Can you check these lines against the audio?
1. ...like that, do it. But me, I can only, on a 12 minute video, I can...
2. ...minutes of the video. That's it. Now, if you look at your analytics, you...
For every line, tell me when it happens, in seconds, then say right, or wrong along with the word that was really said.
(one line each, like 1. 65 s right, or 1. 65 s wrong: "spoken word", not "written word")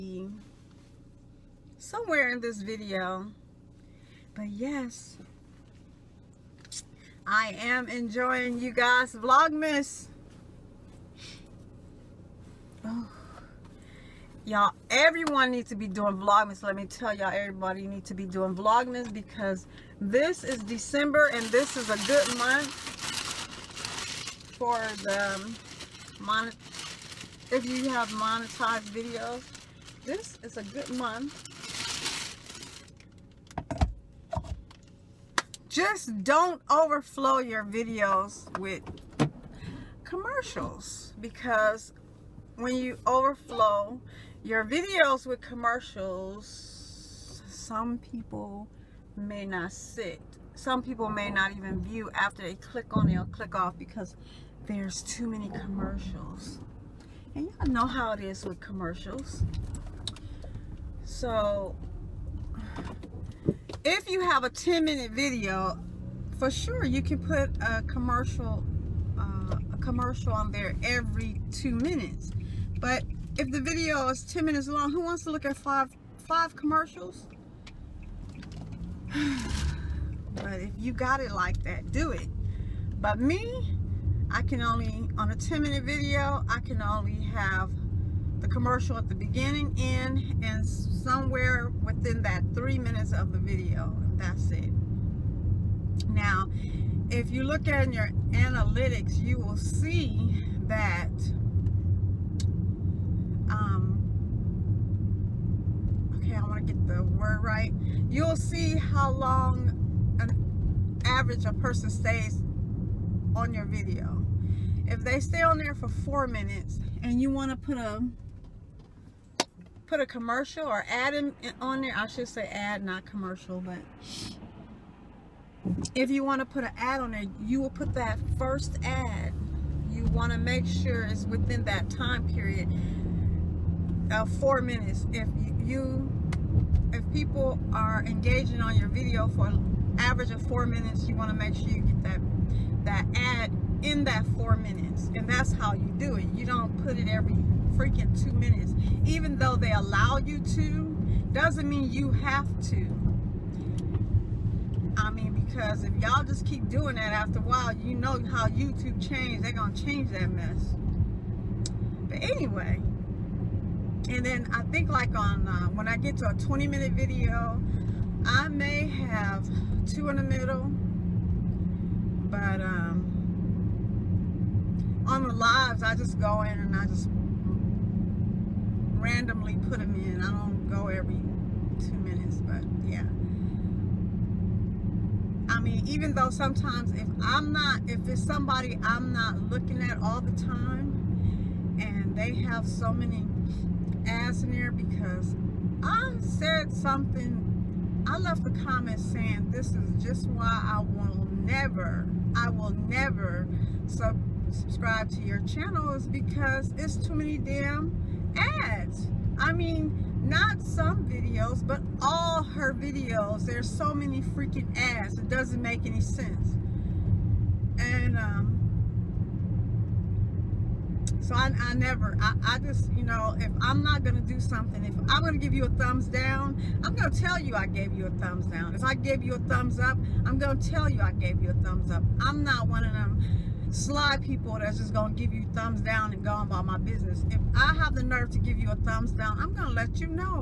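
1. 81 s wrong: "10", not "12"
2. 92 s right.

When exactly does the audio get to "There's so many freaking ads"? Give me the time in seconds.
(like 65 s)
213 s.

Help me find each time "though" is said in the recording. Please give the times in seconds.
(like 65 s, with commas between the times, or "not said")
149 s, 186 s.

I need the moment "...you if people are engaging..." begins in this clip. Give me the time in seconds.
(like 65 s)
135 s.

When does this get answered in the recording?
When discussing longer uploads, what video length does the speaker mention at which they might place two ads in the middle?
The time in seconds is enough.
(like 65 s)
166 s.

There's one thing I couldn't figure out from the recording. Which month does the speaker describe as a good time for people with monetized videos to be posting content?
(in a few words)
December.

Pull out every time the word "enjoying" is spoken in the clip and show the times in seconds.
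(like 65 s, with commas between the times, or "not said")
7 s.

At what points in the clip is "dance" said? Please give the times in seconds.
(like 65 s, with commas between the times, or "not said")
not said.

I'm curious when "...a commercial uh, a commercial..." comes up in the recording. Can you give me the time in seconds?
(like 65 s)
67 s.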